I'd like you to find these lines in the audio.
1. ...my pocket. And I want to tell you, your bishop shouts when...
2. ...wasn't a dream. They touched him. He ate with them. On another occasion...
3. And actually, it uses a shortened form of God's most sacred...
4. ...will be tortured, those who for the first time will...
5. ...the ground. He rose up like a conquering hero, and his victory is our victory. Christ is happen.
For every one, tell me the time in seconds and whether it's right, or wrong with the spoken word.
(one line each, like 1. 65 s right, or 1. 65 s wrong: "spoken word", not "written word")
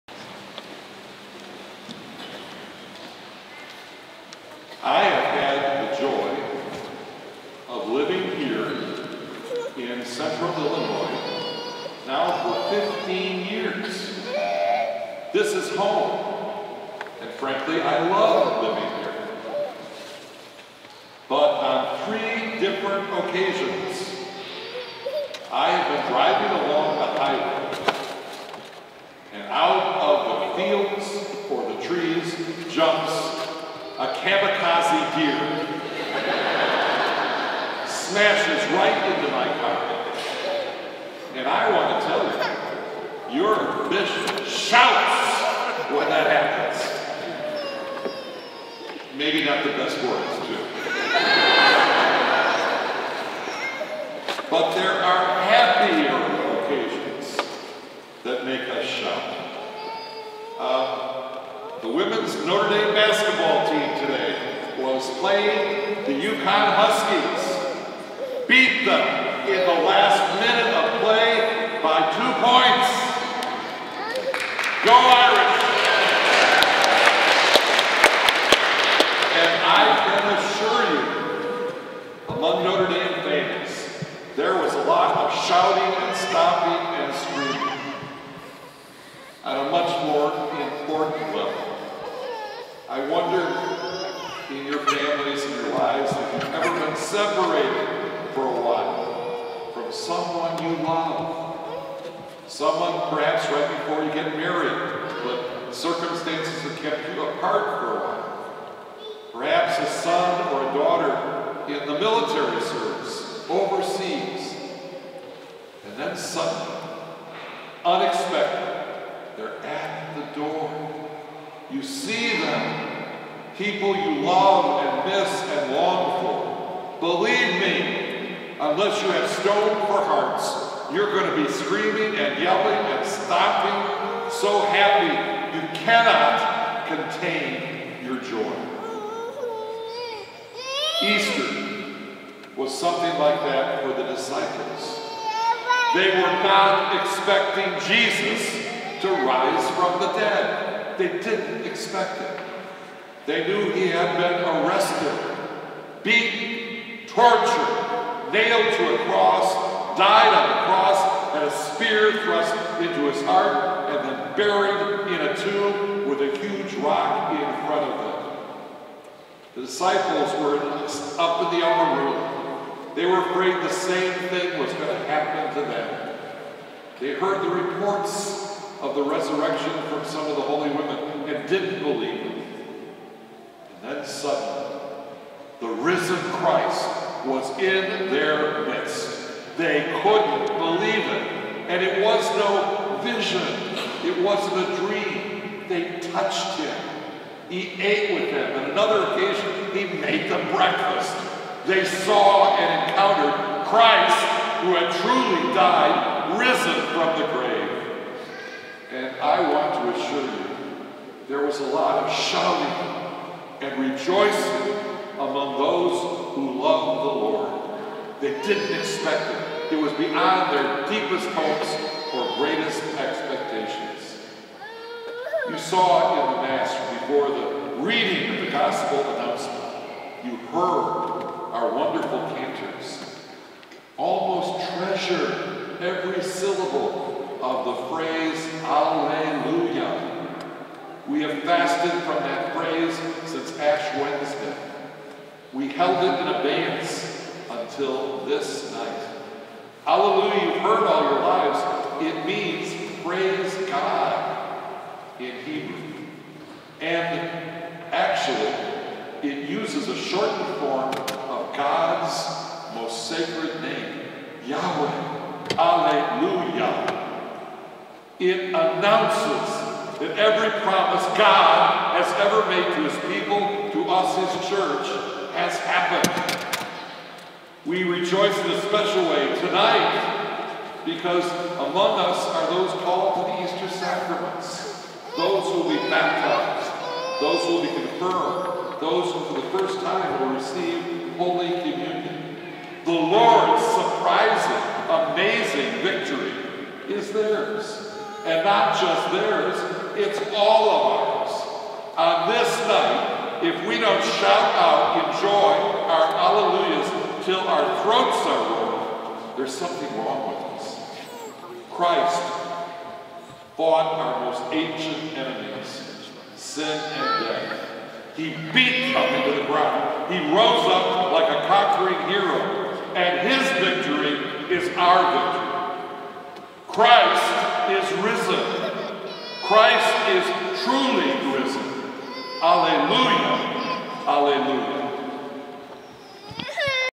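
1. 39 s right
2. 194 s right
3. 256 s right
4. 287 s wrong: "confirmed", not "tortured"
5. 319 s wrong: "risen", not "happen".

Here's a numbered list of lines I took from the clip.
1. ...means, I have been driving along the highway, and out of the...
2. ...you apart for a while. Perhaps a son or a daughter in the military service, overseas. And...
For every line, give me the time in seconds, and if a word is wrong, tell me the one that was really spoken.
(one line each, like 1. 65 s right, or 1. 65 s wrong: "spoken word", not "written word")
1. 23 s wrong: "occasions", not "means"
2. 107 s right.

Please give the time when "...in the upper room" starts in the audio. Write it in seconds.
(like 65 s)
171 s.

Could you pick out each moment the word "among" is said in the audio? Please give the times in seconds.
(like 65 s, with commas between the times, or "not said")
82 s, 215 s, 281 s.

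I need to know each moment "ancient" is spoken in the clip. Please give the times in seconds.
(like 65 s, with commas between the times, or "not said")
314 s.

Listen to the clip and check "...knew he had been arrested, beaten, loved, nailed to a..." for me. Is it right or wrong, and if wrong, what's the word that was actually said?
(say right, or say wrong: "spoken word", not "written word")
wrong: "tortured", not "loved".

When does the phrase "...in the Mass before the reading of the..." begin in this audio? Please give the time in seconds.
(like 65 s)
226 s.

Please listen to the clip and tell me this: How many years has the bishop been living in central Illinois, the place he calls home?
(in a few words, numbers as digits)
15.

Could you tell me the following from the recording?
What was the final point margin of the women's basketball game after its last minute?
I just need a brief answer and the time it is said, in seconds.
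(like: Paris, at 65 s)
2 points, at 72 s.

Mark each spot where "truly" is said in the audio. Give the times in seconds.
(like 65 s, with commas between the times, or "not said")
204 s, 330 s.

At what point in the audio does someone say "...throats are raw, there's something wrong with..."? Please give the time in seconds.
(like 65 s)
307 s.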